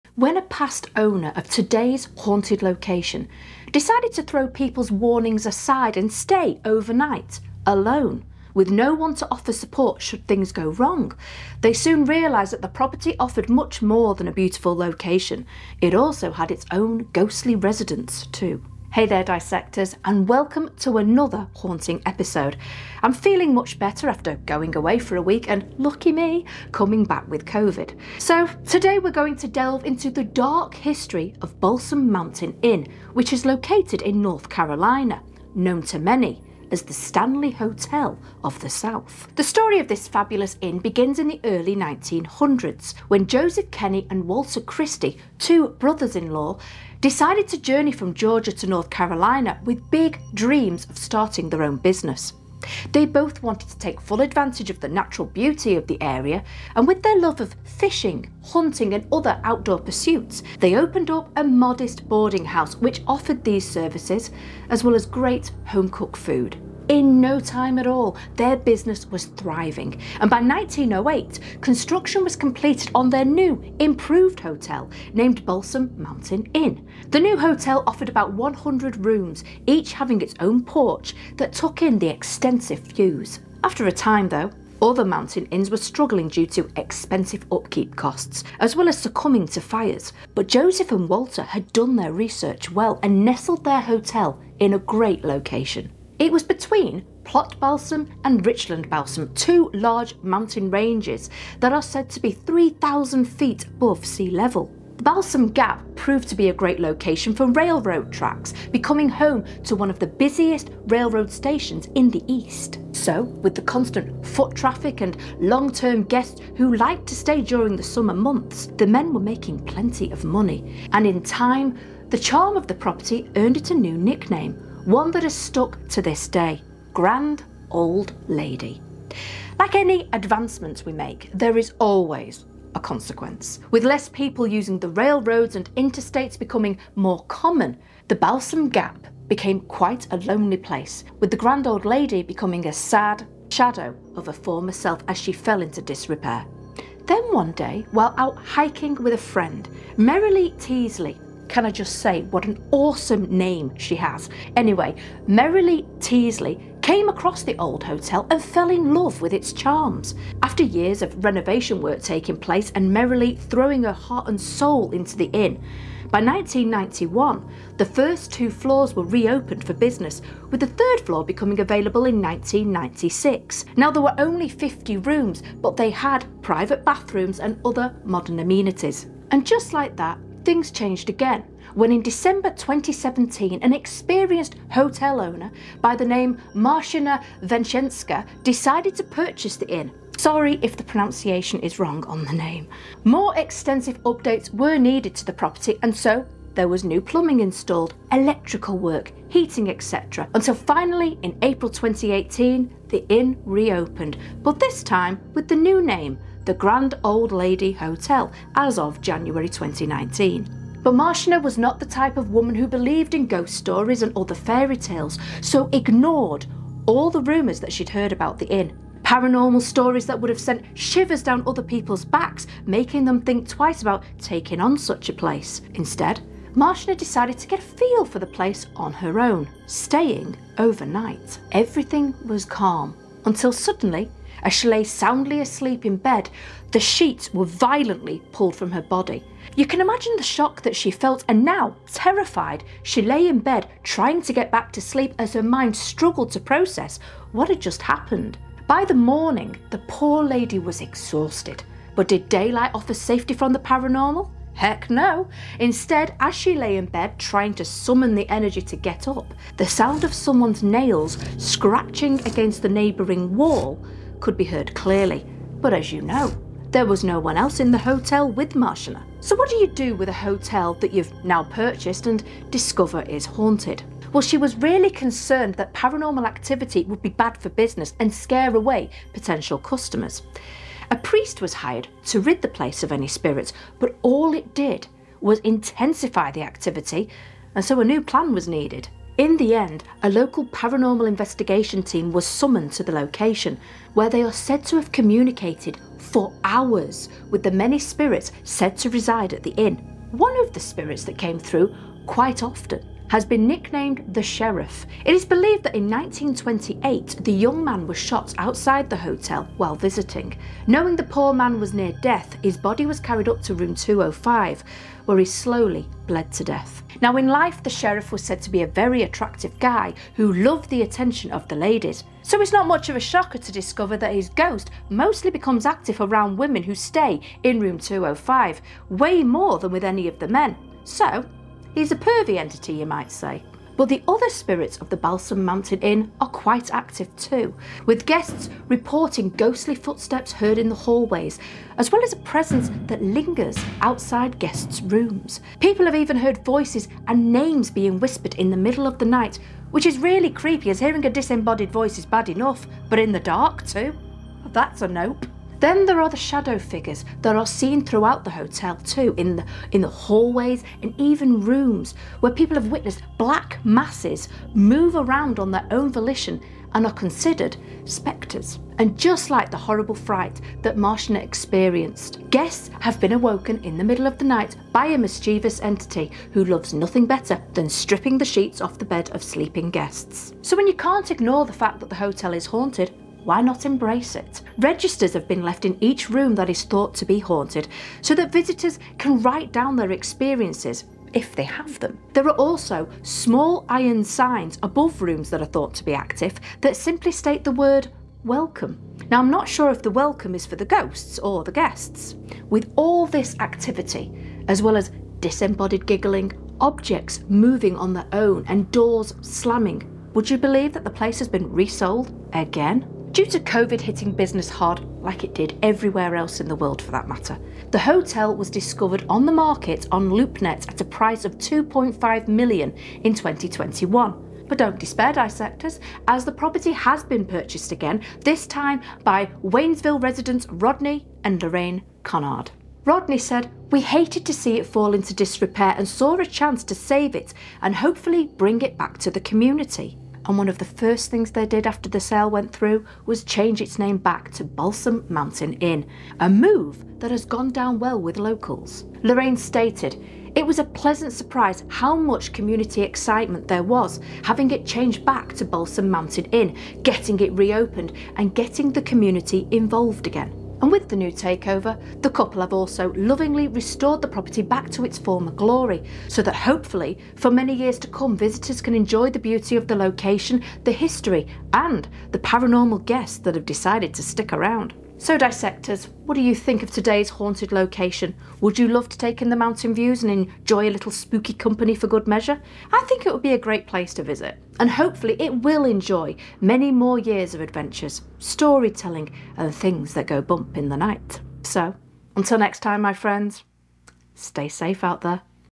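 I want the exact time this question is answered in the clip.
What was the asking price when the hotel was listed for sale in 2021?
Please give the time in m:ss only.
7:01.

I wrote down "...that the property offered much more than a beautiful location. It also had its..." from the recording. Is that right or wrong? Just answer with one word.
right.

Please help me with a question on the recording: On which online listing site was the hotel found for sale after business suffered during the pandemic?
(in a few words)
LoopNet.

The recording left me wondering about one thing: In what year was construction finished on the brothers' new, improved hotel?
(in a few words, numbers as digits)
1908.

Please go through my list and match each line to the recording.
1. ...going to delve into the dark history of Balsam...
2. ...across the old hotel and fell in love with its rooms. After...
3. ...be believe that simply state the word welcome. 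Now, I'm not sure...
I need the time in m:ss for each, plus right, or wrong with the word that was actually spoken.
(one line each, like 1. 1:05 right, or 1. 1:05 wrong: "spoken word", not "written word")
1. 0:29 right
2. 2:37 wrong: "charms", not "rooms"
3. 6:35 wrong: "active", not "believe".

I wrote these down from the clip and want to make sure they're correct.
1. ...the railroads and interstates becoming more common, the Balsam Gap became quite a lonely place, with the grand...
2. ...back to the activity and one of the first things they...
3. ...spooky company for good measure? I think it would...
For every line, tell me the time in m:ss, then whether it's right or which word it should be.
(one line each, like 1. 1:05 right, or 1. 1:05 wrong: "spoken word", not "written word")
1. 2:14 right
2. 7:18 wrong: "community", not "activity"
3. 8:00 right.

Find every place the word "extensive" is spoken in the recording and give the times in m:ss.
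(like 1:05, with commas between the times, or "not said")
1:22, 3:13.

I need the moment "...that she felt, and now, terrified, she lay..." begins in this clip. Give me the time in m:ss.
4:00.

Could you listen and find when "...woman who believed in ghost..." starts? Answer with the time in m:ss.
3:32.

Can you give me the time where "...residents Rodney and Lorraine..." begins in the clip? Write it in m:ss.
7:10.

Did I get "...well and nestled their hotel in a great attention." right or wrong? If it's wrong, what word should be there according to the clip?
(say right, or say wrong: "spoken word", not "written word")
wrong: "location", not "attention".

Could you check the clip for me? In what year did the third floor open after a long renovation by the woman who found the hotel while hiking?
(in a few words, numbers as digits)
1996.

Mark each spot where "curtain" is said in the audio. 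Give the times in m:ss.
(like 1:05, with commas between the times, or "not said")
not said.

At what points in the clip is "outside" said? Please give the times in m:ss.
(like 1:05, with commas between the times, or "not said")
5:08, 5:43.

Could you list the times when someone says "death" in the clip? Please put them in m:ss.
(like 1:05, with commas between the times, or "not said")
5:12, 5:16.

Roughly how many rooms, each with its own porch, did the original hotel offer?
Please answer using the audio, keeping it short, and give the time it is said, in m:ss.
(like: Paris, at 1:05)
100, at 1:18.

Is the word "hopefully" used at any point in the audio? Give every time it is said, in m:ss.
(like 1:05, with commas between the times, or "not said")
7:17, 7:46, 8:04.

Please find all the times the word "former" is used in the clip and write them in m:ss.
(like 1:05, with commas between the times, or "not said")
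2:24, 7:44.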